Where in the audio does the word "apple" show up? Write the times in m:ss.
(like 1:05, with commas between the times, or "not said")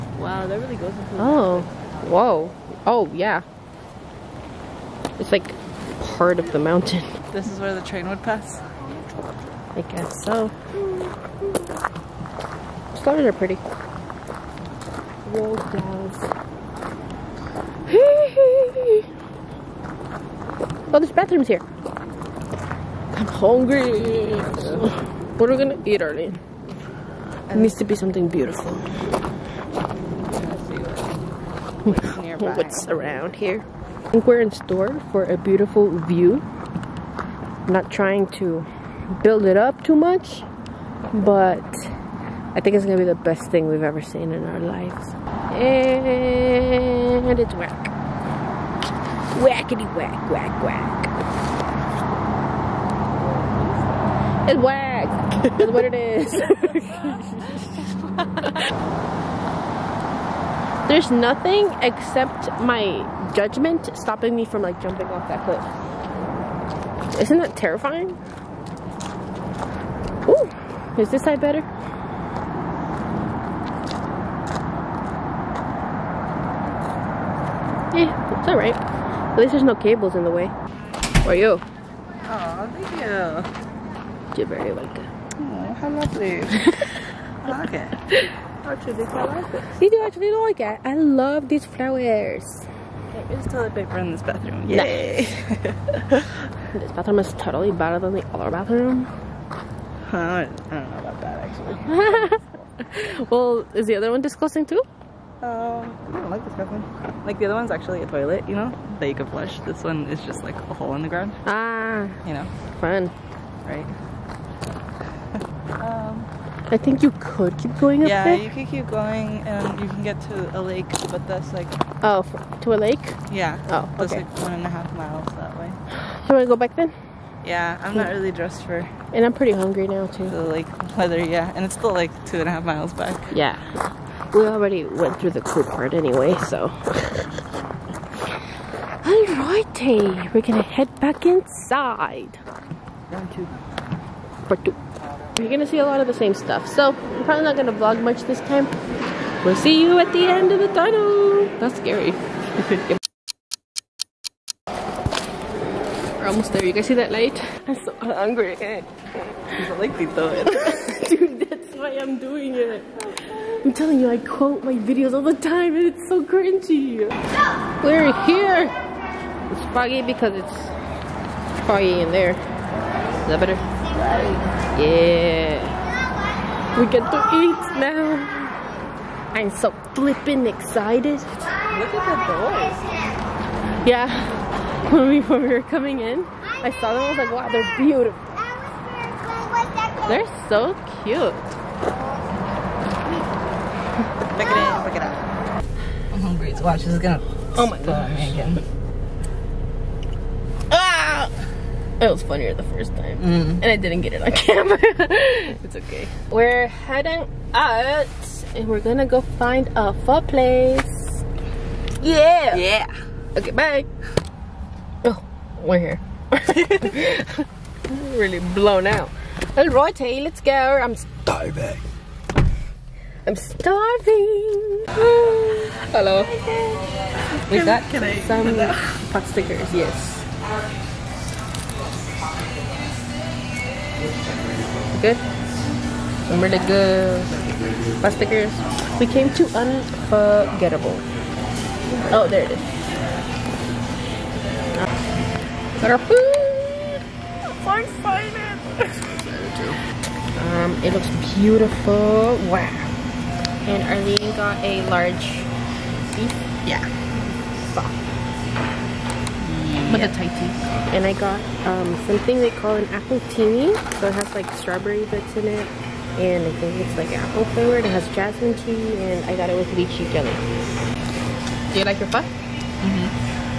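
4:22, 4:27.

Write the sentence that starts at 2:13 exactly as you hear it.
Yeah, we already went through the cool part anyway, so.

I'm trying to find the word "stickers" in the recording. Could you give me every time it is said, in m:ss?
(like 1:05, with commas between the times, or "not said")
3:49, 3:58.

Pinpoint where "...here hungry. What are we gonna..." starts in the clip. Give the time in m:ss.
0:21.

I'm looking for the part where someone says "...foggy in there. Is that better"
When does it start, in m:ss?
2:51.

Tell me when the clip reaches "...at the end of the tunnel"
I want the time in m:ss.
2:29.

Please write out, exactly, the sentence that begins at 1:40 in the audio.
I don't know about that actually.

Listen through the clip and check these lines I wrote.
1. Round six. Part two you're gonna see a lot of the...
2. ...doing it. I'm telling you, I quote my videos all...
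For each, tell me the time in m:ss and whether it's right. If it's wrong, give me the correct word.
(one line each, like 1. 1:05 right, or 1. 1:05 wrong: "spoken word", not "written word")
1. 2:23 wrong: "two", not "six"
2. 2:42 right.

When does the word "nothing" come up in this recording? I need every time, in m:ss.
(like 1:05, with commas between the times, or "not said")
1:01.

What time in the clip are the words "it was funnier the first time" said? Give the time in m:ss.
3:21.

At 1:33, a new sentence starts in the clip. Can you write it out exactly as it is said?
There is toilet paper in this bathroom.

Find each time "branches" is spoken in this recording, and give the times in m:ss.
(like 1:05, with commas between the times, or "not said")
not said.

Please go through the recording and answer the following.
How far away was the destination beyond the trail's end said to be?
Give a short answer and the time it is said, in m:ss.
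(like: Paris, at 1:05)
1.5 miles, at 2:04.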